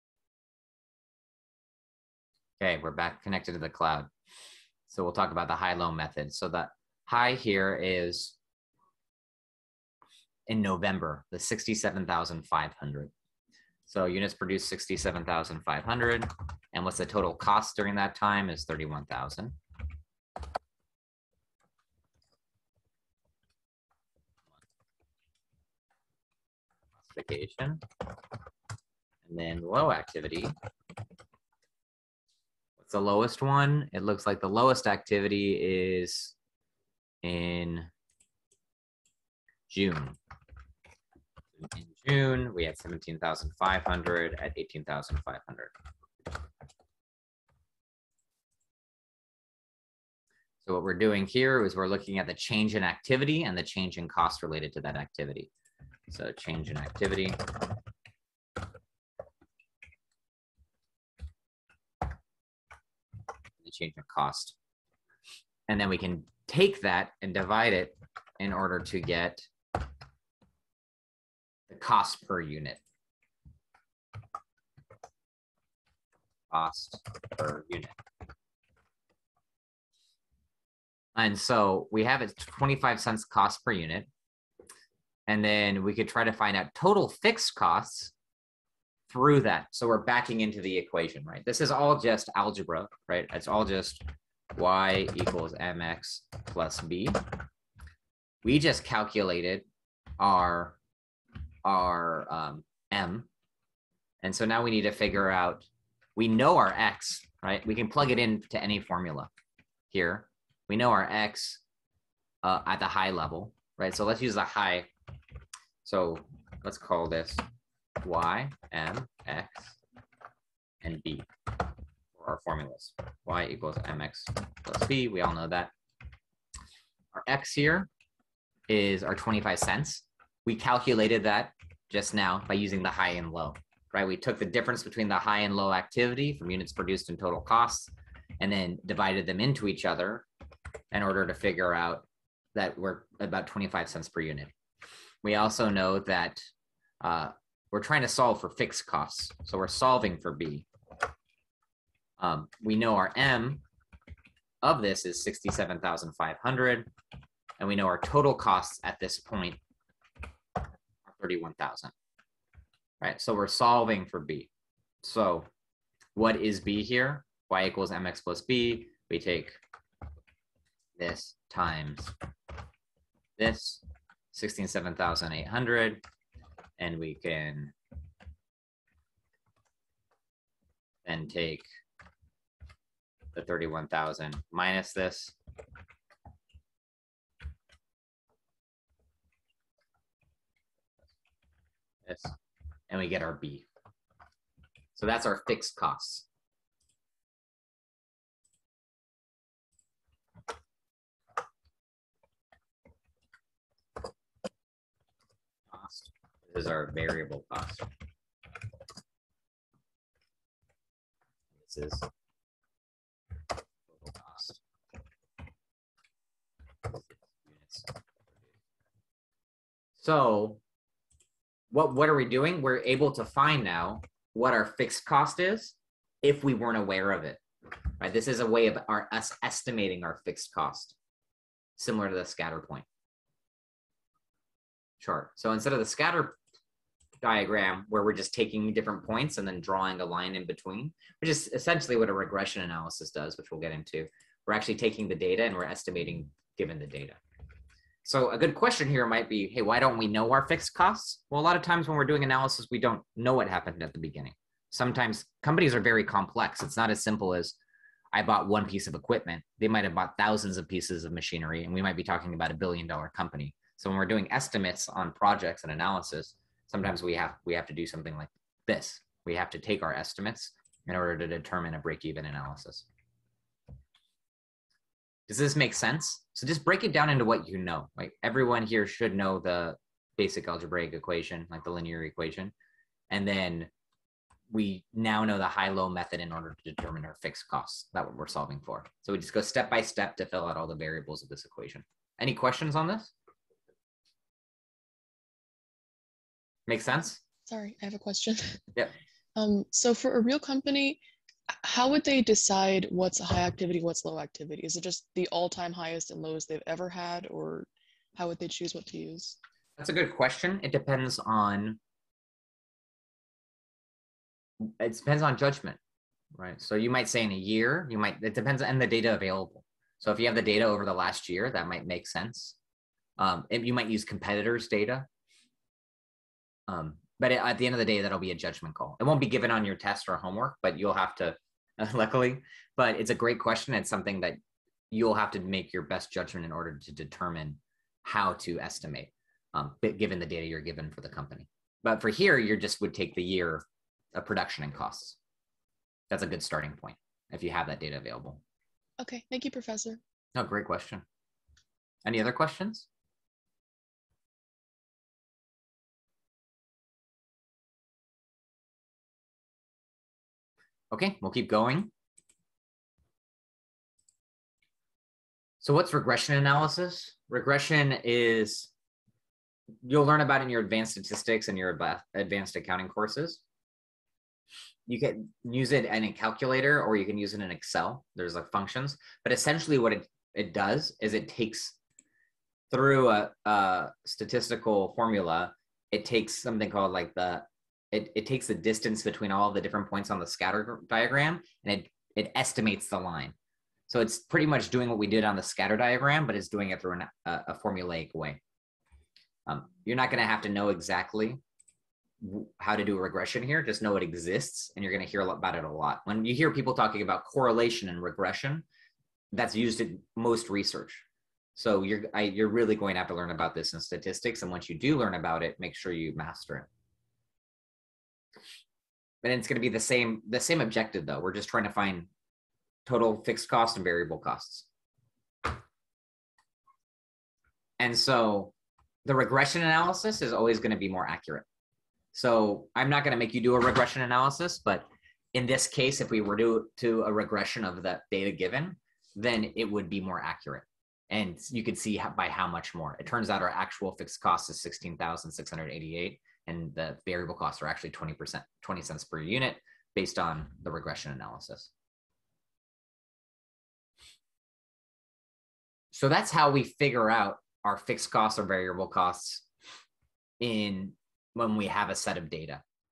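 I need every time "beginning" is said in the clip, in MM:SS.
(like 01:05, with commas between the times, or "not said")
04:13.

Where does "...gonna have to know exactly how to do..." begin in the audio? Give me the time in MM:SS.
06:40.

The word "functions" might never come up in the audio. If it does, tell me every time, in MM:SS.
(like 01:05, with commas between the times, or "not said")
06:18.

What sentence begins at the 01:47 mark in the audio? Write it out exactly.
We can plug it into any formula here.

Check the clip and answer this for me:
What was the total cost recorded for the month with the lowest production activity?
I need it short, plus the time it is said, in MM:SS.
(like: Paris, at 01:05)
18,500, at 00:44.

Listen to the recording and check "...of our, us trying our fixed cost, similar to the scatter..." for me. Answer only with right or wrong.
wrong.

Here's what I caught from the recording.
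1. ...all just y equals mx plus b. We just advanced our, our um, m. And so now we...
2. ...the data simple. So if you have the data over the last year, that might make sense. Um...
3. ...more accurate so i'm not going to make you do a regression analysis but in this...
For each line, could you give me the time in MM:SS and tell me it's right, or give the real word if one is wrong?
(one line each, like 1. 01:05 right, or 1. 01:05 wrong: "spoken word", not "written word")
1. 01:33 wrong: "calculated", not "advanced"
2. 05:18 wrong: "available", not "simple"
3. 07:10 right.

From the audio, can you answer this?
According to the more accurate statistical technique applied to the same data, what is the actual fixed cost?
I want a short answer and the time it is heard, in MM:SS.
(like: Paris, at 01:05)
16,688, at 07:24.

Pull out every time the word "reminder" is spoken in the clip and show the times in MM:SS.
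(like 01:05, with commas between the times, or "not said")
not said.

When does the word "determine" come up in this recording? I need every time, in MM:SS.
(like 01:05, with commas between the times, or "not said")
04:31, 04:46, 05:36.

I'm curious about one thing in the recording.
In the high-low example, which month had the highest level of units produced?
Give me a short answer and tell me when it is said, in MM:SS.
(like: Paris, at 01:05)
November, at 00:10.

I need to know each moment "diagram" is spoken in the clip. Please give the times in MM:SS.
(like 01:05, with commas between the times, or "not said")
03:57, 06:30, 06:35.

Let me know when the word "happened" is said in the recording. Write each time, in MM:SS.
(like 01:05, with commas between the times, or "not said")
04:13.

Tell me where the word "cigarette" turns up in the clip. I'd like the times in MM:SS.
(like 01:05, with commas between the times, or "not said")
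not said.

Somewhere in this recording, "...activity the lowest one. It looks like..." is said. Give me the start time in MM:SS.
00:29.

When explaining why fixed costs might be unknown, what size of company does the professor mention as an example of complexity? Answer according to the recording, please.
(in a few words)
billion dollar company.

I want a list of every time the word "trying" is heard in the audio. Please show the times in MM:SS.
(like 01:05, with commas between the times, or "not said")
02:27, 07:01.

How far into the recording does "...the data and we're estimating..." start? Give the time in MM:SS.
04:05.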